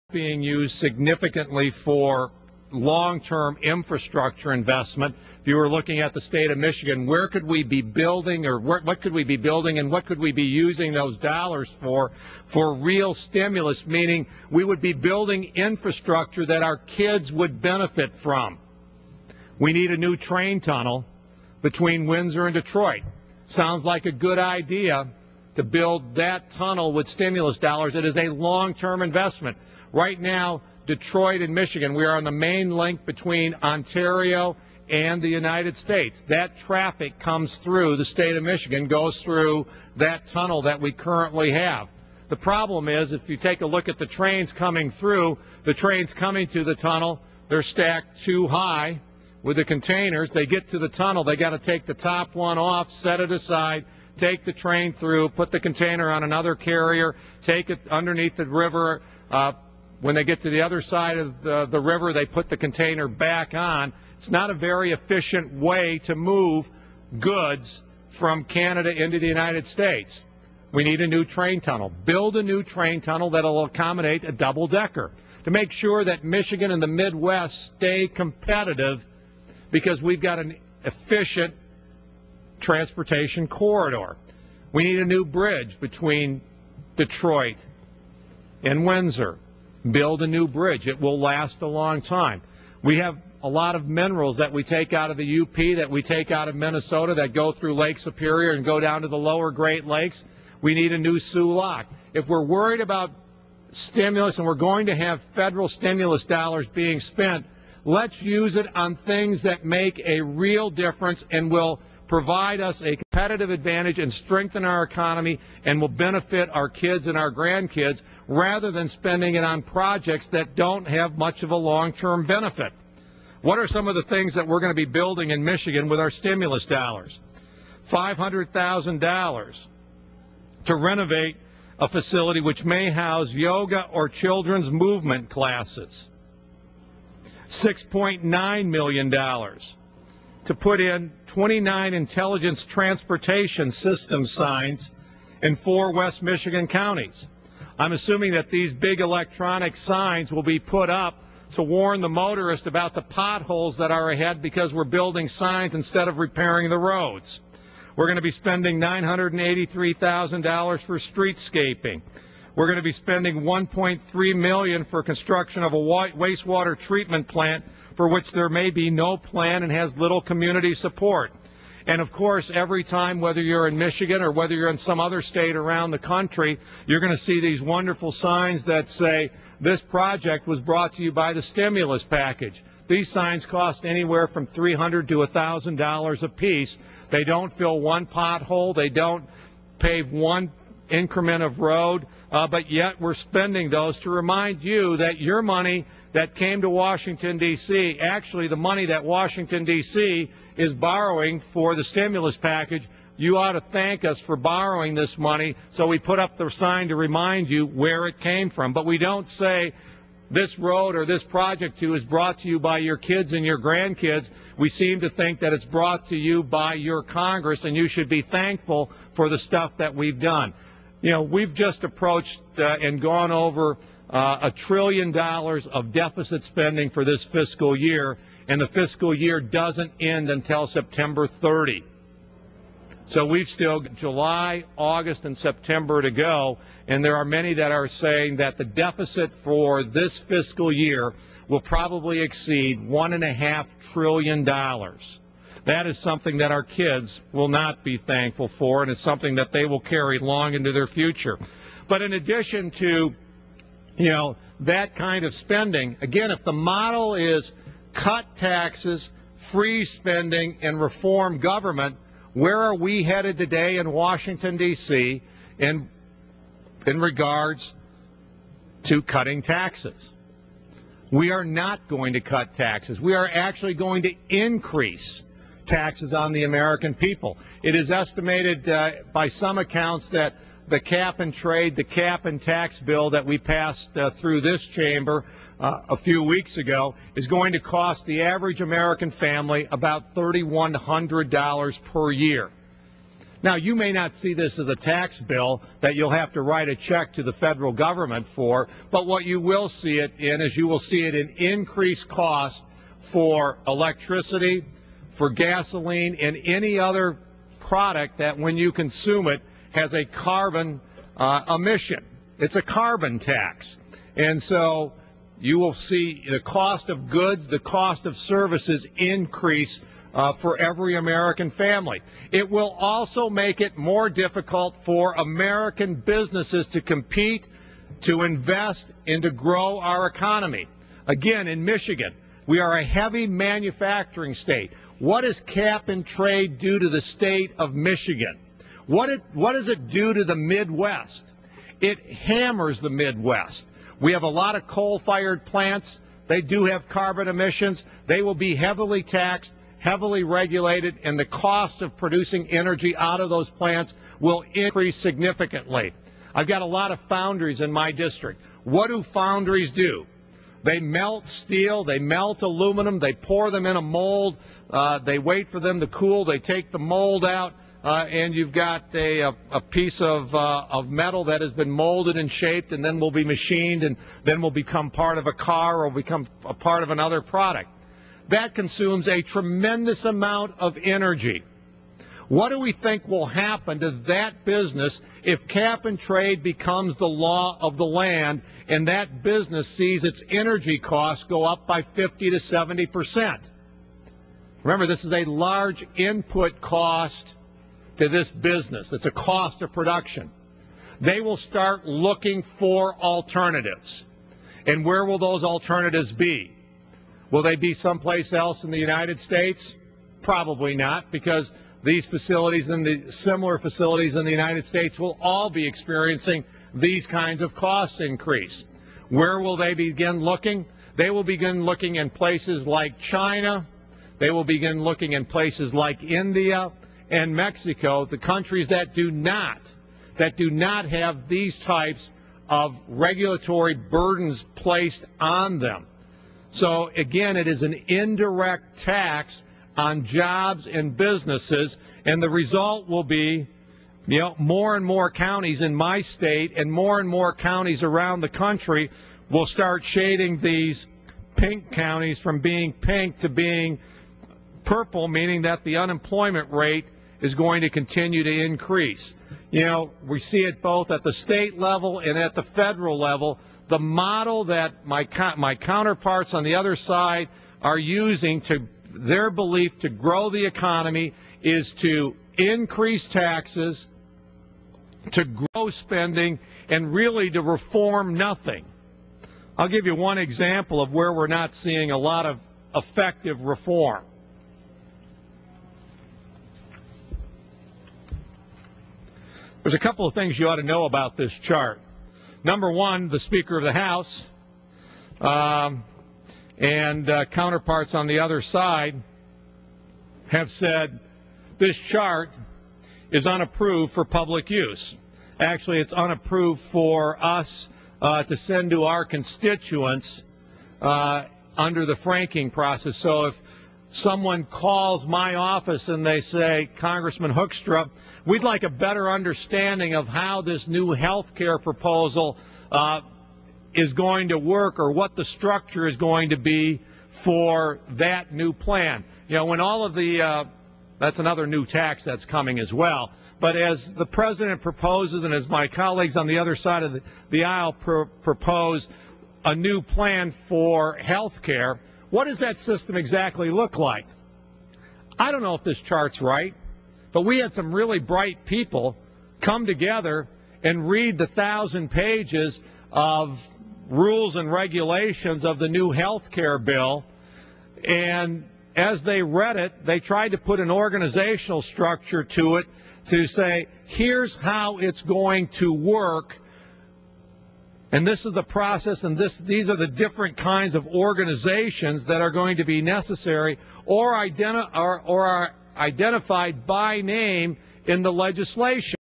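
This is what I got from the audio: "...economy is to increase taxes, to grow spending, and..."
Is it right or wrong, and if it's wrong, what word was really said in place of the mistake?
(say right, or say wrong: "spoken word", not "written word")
right.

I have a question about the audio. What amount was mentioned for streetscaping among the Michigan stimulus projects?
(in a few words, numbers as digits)
$983,000.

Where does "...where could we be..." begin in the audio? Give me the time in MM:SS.
00:07.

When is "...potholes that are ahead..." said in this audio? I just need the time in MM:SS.
02:33.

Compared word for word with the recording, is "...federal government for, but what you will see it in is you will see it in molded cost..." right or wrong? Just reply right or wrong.
wrong.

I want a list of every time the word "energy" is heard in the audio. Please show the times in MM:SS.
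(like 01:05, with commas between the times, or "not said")
05:52, 06:20, 06:30.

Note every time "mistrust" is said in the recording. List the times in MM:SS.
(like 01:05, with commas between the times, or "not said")
not said.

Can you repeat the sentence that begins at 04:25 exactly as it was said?
in, in regards to cutting taxes?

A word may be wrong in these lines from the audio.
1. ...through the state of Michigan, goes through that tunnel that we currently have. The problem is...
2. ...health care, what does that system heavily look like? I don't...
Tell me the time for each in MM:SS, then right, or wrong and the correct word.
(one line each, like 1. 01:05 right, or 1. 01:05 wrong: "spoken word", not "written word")
1. 00:37 right
2. 09:00 wrong: "exactly", not "heavily".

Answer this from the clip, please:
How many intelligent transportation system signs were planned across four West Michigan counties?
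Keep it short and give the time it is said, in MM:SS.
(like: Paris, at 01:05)
29, at 02:21.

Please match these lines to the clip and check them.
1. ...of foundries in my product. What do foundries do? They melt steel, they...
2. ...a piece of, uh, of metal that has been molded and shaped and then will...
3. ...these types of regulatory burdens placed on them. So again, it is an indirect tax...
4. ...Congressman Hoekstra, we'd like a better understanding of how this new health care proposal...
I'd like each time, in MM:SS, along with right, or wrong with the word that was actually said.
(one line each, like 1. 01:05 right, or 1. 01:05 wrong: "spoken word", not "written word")
1. 05:56 wrong: "district", not "product"
2. 06:09 right
3. 07:11 right
4. 08:36 right.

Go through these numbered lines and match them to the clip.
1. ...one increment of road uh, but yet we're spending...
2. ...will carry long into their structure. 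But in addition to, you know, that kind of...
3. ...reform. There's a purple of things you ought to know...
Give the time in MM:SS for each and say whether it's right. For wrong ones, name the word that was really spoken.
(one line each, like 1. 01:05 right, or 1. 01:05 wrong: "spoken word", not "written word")
1. 03:10 right
2. 04:09 wrong: "future", not "structure"
3. 08:03 wrong: "couple", not "purple".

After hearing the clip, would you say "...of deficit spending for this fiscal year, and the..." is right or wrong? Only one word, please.
right.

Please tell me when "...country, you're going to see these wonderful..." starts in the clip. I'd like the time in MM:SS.
02:55.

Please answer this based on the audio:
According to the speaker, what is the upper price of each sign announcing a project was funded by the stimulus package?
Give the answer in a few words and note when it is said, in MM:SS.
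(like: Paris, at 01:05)
$1,000, at 03:05.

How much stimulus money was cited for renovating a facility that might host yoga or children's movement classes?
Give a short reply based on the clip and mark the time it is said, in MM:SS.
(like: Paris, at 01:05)
$500,000, at 02:07.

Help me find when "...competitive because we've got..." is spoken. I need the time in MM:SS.
01:18.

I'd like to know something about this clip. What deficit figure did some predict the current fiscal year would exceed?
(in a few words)
$1.5 trillion.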